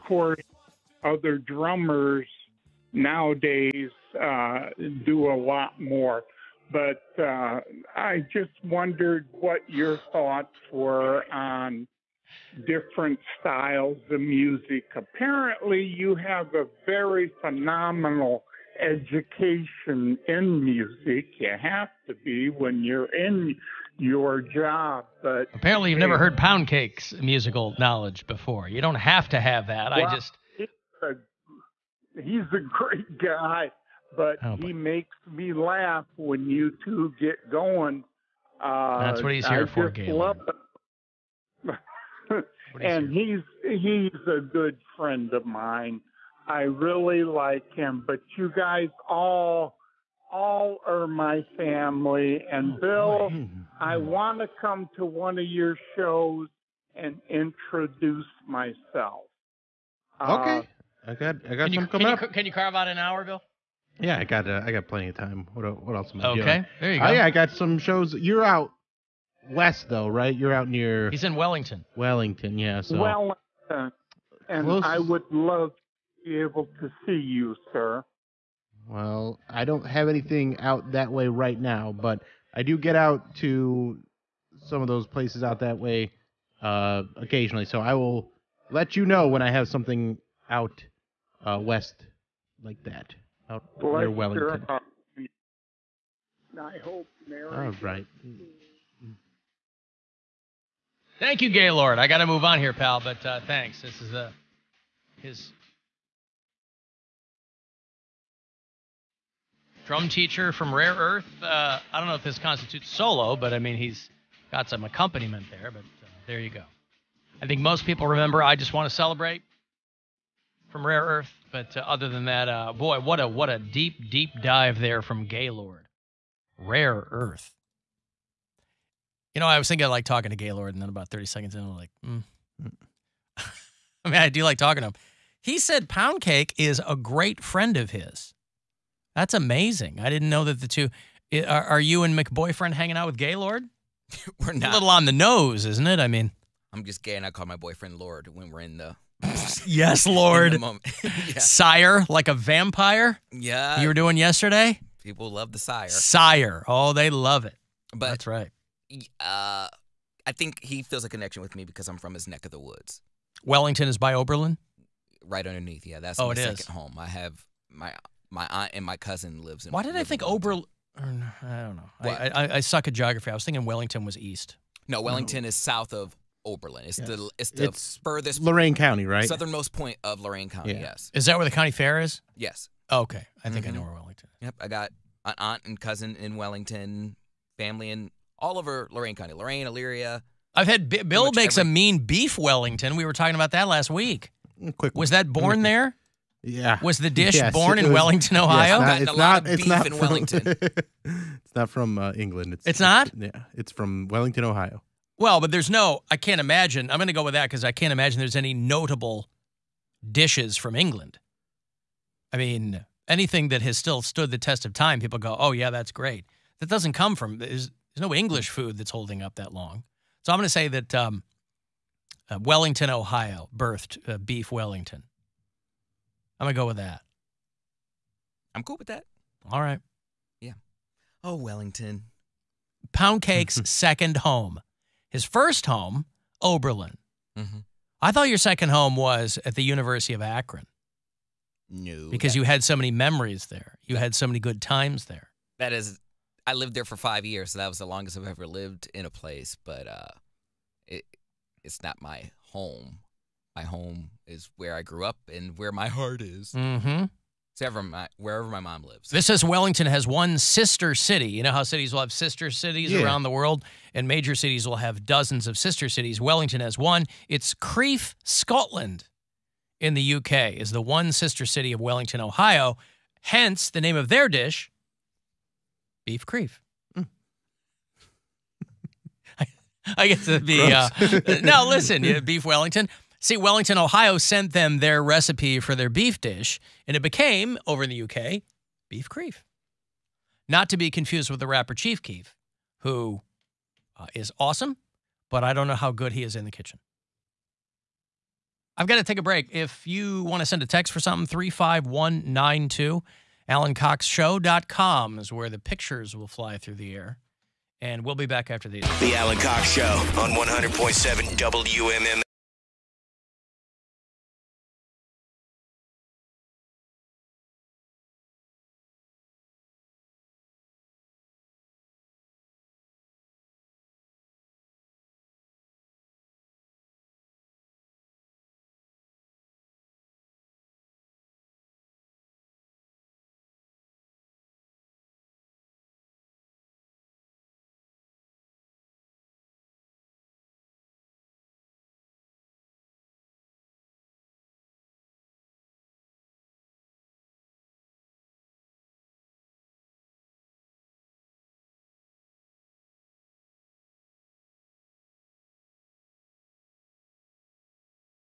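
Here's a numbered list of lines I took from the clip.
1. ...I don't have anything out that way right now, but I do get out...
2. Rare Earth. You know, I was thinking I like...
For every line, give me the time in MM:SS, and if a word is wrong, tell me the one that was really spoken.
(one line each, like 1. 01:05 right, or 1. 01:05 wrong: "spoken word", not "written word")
1. 01:19 right
2. 02:06 right.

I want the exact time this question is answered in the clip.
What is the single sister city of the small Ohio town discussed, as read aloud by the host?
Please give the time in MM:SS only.
04:27.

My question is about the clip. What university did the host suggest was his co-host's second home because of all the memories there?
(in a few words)
University of Akron.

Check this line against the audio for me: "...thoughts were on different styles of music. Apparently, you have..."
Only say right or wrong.
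right.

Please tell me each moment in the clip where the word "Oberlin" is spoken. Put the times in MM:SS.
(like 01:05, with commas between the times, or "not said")
02:44, 02:50, 02:56, 03:56.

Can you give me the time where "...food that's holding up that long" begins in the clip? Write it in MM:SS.
03:38.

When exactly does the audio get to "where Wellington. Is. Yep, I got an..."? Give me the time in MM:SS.
03:03.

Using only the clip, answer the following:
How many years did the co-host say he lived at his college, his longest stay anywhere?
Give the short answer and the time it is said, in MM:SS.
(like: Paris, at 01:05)
5, at 04:06.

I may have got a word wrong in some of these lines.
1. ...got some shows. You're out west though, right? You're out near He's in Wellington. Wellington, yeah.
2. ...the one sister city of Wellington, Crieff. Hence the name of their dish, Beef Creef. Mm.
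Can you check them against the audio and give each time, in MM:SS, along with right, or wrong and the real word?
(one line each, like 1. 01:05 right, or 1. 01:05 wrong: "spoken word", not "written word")
1. 01:07 right
2. 04:30 wrong: "Ohio", not "Crieff".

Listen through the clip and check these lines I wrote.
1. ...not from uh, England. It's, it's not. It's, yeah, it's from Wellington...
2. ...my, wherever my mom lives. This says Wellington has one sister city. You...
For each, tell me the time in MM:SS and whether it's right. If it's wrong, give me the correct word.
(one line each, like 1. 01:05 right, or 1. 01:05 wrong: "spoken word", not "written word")
1. 03:21 right
2. 04:17 right.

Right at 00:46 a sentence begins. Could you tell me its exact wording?
I really like him, but you guys all all are my family.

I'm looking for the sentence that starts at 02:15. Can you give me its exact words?
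He said Pound Cake is a great friend of his.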